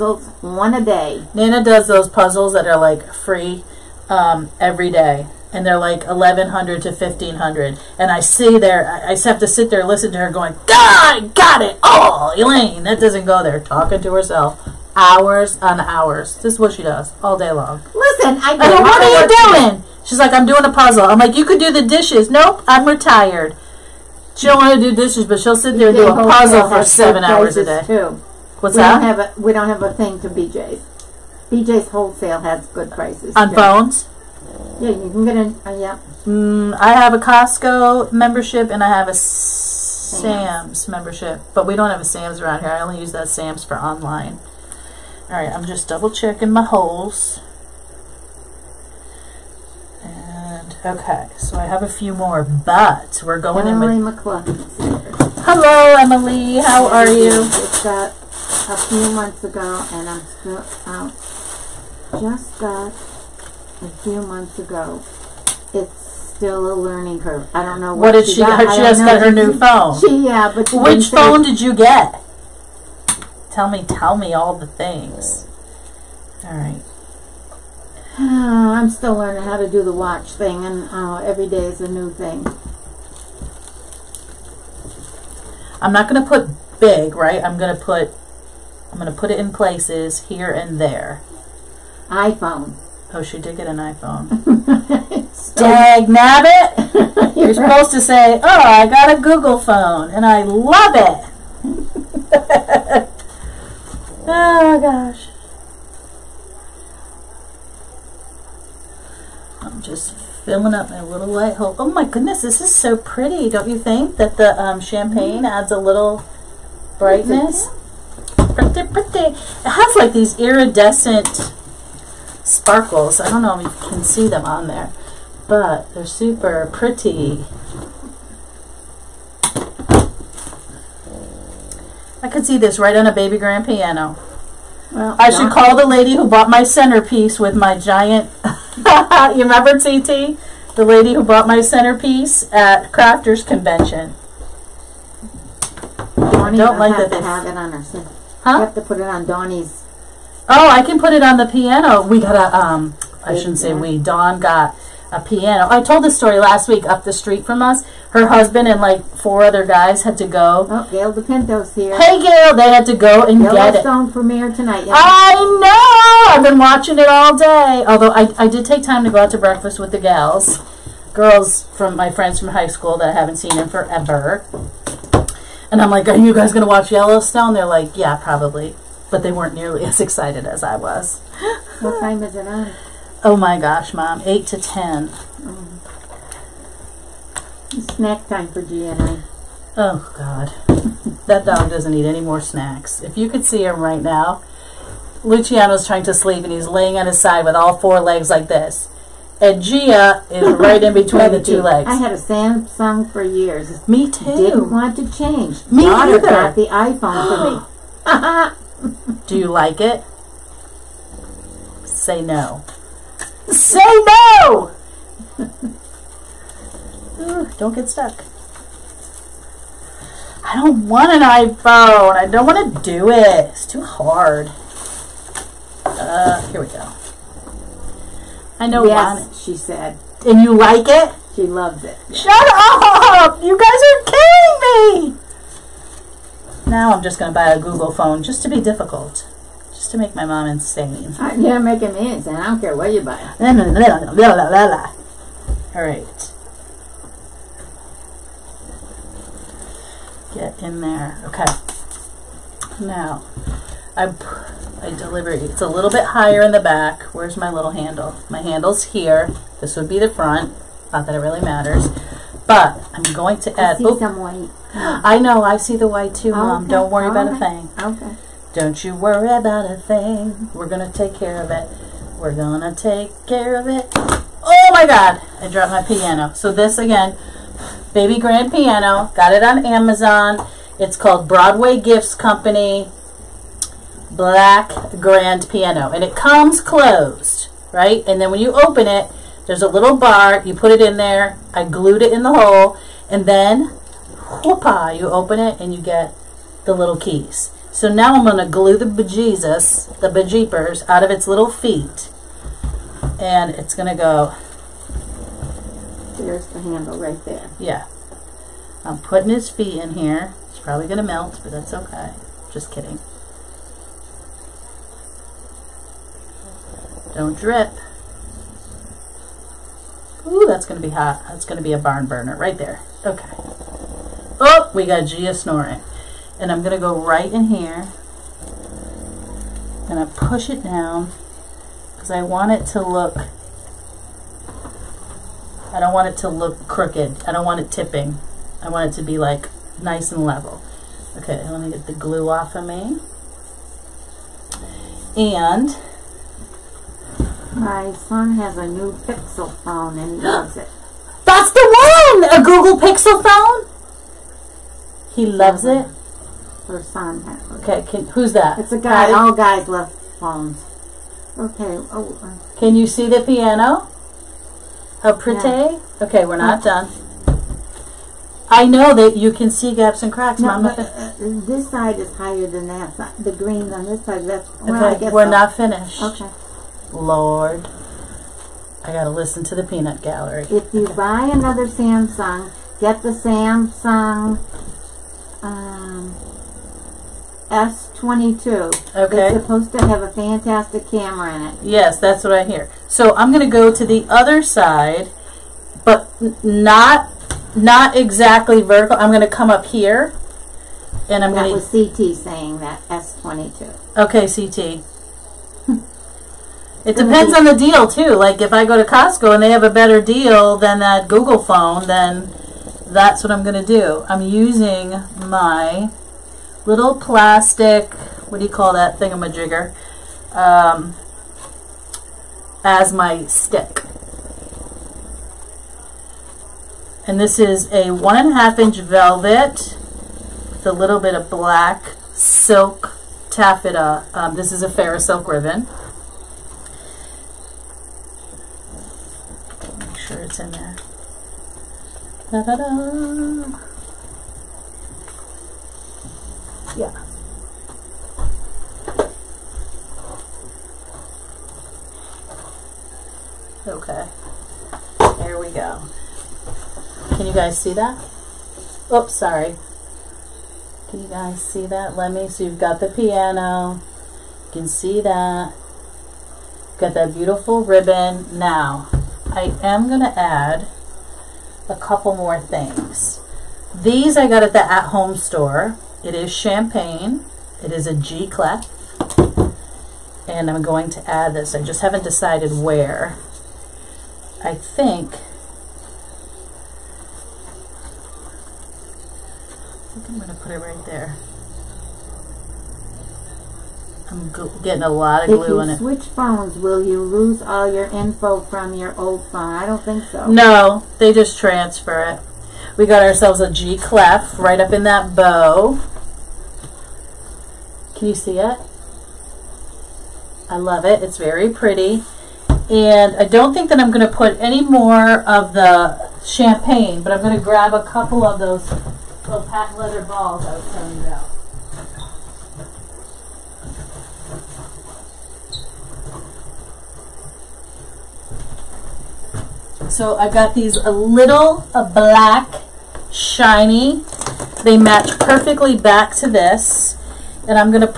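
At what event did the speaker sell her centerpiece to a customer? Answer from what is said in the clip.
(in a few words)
Crafters Convention.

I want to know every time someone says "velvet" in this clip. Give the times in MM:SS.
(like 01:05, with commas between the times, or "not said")
07:08.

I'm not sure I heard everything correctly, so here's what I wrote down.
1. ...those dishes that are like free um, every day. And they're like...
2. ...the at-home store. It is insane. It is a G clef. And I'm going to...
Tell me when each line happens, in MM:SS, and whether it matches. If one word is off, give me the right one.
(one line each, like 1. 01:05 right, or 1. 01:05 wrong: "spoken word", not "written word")
1. 00:01 wrong: "puzzles", not "dishes"
2. 07:54 wrong: "champagne", not "insane".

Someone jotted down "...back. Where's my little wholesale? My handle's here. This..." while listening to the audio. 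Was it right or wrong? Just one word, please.
wrong.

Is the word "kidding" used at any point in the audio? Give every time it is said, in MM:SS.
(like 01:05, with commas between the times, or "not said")
03:54, 05:12.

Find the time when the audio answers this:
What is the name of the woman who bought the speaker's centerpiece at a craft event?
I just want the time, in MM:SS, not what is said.
02:19.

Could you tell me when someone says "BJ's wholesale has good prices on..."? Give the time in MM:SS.
00:31.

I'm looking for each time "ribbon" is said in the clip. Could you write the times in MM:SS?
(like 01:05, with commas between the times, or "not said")
07:15, 07:47.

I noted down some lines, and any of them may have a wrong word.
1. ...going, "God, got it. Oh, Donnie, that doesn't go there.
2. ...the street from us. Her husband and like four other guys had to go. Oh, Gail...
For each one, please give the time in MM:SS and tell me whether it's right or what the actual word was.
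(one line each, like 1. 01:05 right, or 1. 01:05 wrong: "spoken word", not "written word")
1. 00:10 wrong: "Elaine", not "Donnie"
2. 02:37 right.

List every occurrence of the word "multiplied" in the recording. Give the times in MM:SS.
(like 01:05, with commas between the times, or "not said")
not said.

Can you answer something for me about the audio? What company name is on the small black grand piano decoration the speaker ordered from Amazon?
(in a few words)
Broadway Gifts Company.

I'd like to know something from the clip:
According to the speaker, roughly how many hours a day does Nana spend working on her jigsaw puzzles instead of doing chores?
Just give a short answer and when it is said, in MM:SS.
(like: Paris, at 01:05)
7, at 00:26.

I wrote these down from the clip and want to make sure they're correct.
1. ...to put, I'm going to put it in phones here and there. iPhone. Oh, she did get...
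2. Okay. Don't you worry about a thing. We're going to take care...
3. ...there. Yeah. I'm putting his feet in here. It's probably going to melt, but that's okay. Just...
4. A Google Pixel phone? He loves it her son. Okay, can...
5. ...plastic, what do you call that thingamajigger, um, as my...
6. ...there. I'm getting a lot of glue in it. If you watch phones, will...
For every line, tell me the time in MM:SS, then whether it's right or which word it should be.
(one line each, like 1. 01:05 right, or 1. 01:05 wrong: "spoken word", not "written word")
1. 01:27 wrong: "places", not "phones"
2. 04:28 right
3. 05:07 right
4. 05:52 right
5. 06:56 right
6. 08:10 wrong: "switch", not "watch".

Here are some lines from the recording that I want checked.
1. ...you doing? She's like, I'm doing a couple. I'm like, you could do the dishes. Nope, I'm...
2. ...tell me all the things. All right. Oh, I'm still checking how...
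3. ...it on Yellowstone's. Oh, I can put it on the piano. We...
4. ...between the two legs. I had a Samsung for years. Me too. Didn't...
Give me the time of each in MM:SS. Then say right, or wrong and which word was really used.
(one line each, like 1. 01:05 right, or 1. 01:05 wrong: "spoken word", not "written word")
1. 00:19 wrong: "puzzle", not "couple"
2. 01:13 wrong: "learning", not "checking"
3. 02:28 wrong: "Donnie", not "Yellowstone"
4. 03:20 right.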